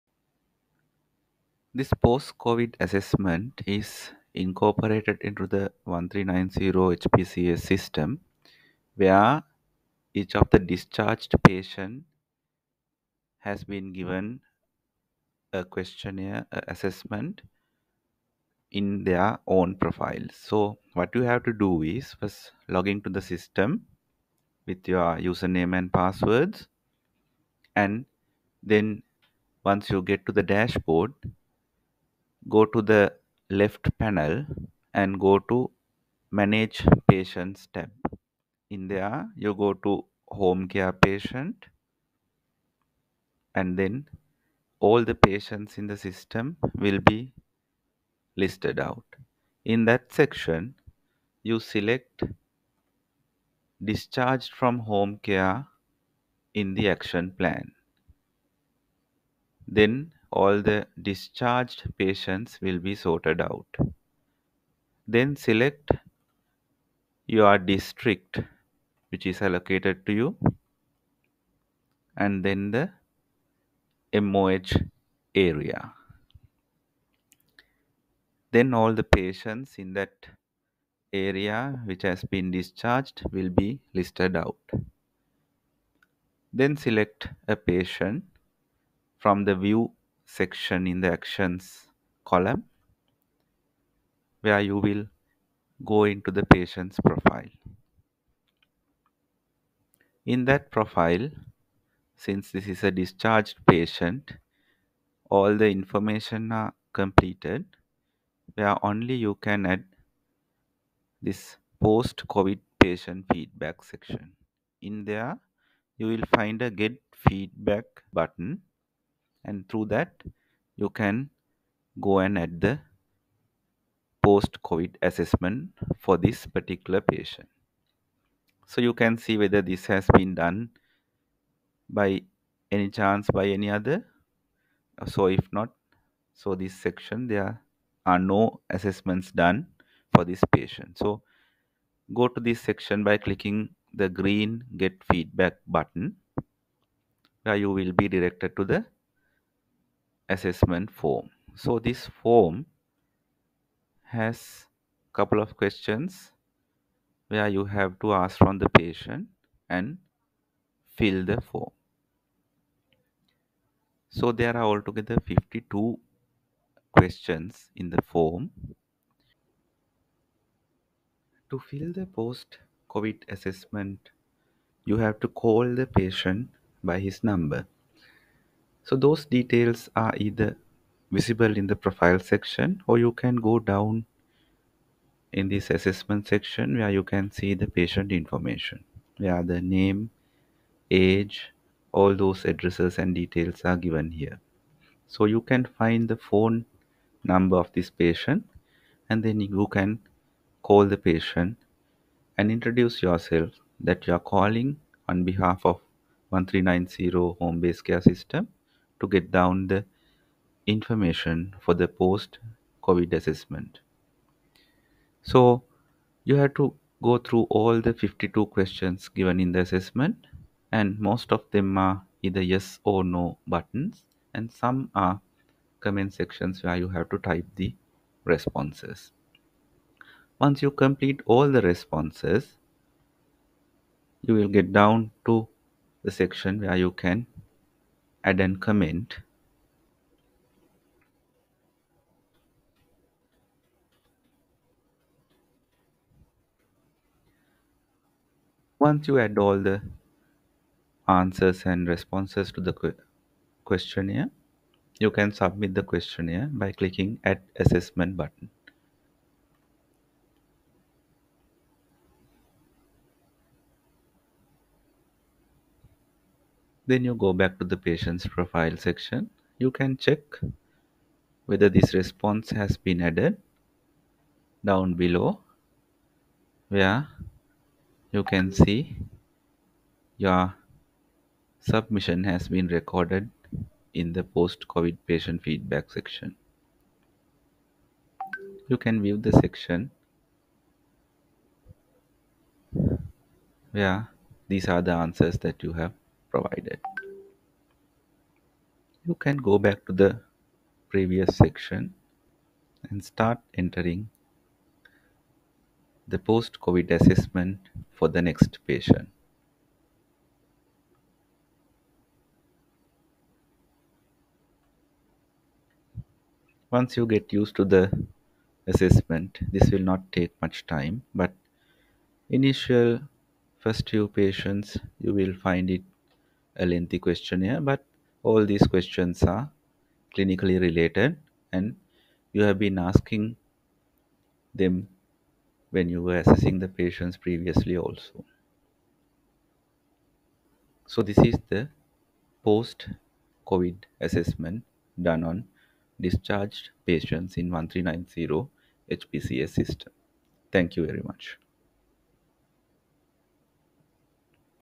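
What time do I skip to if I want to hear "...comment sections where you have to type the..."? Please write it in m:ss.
3:45.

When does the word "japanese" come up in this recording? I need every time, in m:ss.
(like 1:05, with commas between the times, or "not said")
not said.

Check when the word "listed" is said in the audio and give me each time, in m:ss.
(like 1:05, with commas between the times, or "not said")
0:48, 1:23.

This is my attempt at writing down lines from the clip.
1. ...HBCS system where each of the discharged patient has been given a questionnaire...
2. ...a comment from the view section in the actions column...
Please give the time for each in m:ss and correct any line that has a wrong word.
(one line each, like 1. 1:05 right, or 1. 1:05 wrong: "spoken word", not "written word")
1. 0:06 right
2. 1:27 wrong: "patient", not "comment".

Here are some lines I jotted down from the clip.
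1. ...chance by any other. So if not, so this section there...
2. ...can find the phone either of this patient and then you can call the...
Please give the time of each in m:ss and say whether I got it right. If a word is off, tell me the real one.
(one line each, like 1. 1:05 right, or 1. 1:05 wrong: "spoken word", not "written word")
1. 2:12 right
2. 3:15 wrong: "number", not "either".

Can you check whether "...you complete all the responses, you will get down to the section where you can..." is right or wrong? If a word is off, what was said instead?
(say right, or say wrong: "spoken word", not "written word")
right.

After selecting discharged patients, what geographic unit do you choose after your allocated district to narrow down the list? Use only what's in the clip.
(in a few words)
MOH area.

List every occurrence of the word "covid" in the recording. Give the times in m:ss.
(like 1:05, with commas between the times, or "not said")
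0:02, 1:52, 2:04, 2:52, 3:32, 4:44, 5:06, 5:42.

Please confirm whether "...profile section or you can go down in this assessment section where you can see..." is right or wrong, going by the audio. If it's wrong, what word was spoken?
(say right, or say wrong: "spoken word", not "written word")
right.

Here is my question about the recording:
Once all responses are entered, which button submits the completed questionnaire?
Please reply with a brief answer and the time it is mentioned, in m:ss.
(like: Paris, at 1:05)
Add assessment, at 4:17.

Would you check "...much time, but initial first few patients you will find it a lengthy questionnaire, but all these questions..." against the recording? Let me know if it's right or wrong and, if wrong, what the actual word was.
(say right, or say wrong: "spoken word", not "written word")
right.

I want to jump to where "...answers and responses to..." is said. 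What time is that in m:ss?
4:11.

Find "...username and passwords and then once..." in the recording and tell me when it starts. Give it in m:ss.
0:25.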